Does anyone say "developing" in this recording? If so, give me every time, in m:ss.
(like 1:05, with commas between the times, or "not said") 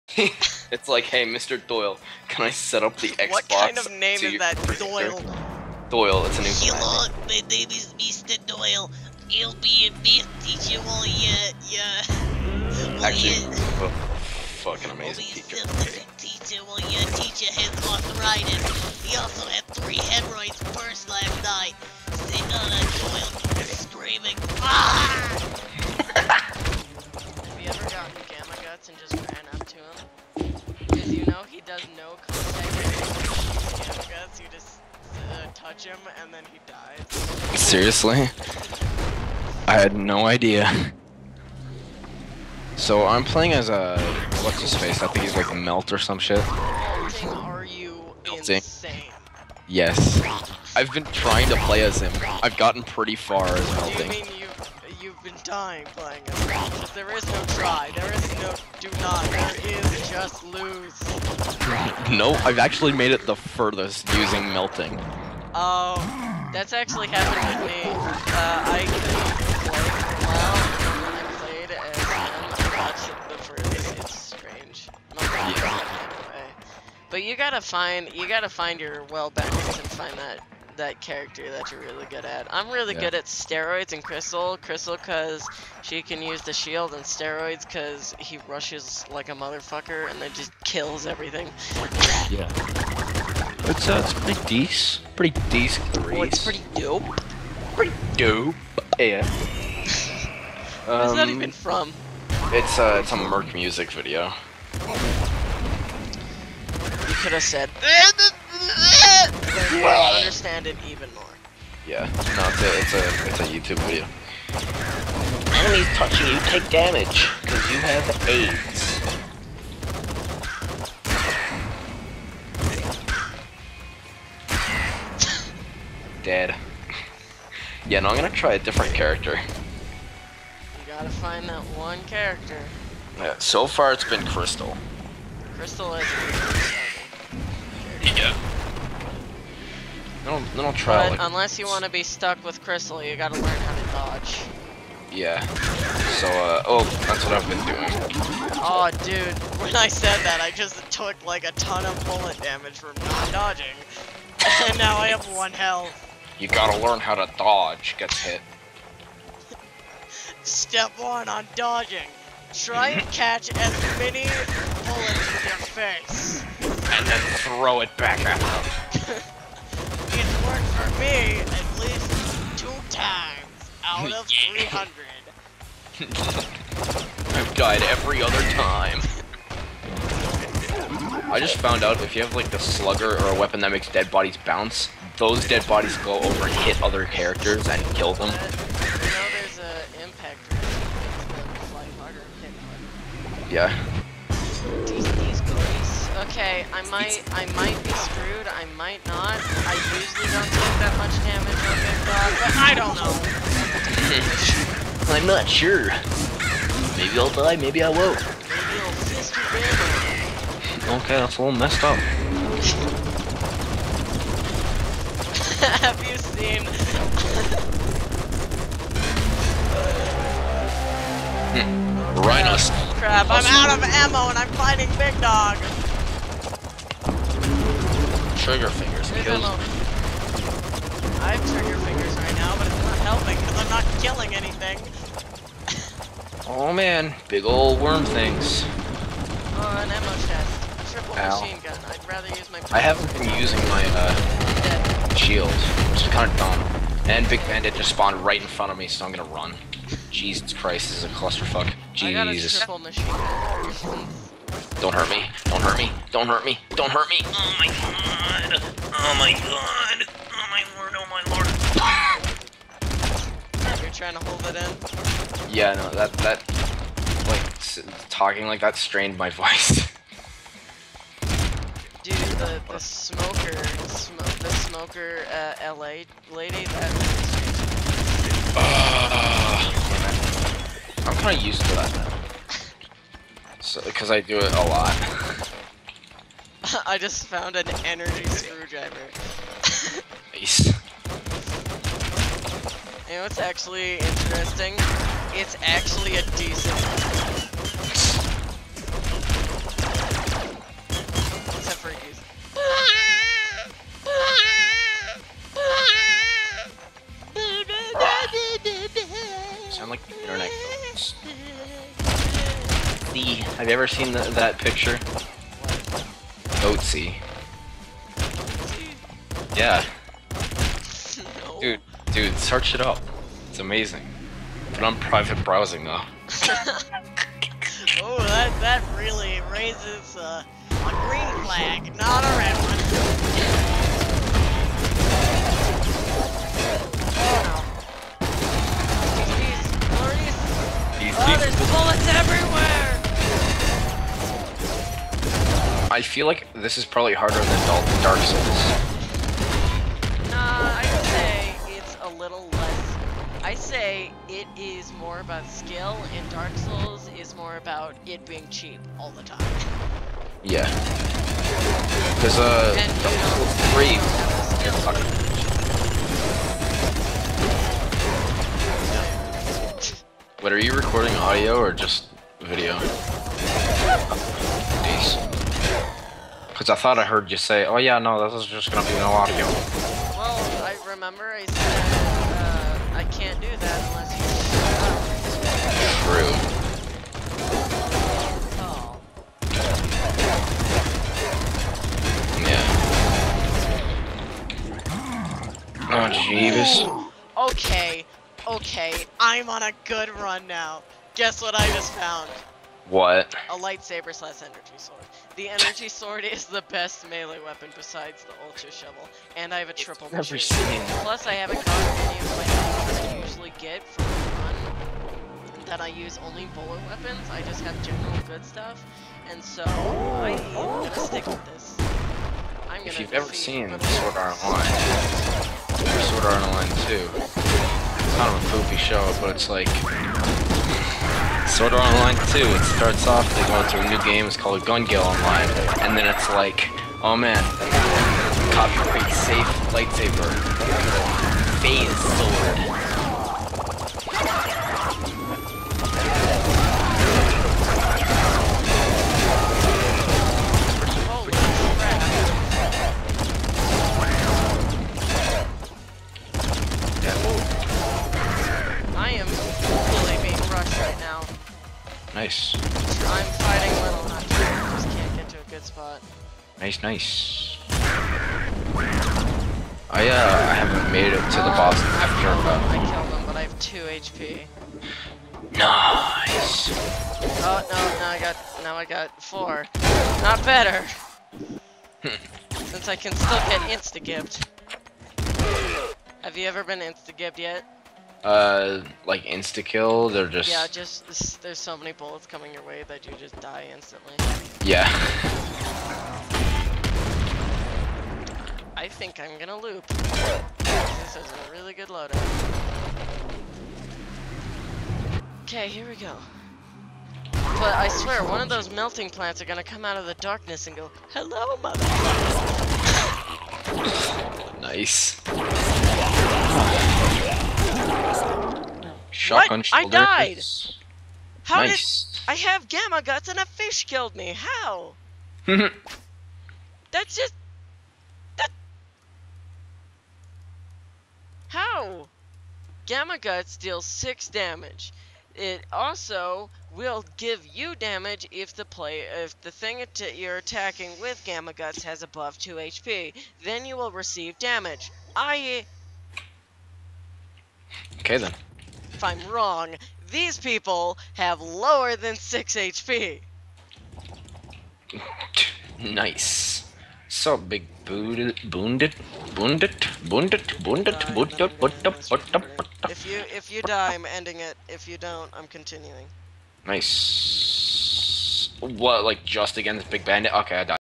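not said.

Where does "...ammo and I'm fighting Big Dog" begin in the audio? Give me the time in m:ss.
3:43.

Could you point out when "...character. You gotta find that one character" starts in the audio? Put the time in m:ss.
2:08.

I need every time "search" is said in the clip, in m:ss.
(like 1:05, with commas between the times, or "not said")
5:22.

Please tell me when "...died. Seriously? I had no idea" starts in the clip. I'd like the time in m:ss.
0:36.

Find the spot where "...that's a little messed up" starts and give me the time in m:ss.
3:31.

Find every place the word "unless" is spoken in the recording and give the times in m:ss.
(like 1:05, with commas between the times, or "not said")
2:21, 6:23.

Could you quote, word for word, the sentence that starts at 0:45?
I think he's like melt or some shit.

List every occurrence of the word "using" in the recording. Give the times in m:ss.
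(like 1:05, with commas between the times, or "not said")
1:04, 4:03.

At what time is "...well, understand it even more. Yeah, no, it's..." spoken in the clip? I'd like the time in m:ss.
1:49.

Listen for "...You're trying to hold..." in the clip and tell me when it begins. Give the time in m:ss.
4:23.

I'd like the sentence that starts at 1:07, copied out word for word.
Uh, I could play for a while, and I played and watched the first.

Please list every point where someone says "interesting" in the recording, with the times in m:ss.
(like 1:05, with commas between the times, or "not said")
4:53.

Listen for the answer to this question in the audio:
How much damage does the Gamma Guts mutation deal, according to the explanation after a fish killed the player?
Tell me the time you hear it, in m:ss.
8:53.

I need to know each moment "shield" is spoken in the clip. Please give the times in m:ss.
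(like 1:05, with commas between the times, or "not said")
1:26, 4:05.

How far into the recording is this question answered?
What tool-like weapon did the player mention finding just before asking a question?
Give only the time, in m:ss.
4:47.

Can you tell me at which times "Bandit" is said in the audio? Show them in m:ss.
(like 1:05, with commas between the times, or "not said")
4:07, 9:30.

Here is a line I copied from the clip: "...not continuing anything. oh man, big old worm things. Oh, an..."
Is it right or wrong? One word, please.
wrong.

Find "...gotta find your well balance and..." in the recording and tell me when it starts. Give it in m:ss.
1:18.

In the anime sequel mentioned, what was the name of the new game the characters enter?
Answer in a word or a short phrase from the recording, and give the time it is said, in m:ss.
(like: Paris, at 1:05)
Gun Gale Online, at 7:14.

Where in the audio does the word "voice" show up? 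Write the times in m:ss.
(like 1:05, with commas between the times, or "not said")
4:29.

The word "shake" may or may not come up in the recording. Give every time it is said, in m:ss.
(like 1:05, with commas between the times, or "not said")
not said.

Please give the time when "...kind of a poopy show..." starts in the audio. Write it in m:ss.
7:08.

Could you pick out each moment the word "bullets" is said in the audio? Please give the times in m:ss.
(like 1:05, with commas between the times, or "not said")
2:32, 2:44, 5:41, 6:56, 8:11.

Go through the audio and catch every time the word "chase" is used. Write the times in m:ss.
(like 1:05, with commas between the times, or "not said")
not said.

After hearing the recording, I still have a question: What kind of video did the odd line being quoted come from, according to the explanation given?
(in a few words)
A Merc music video.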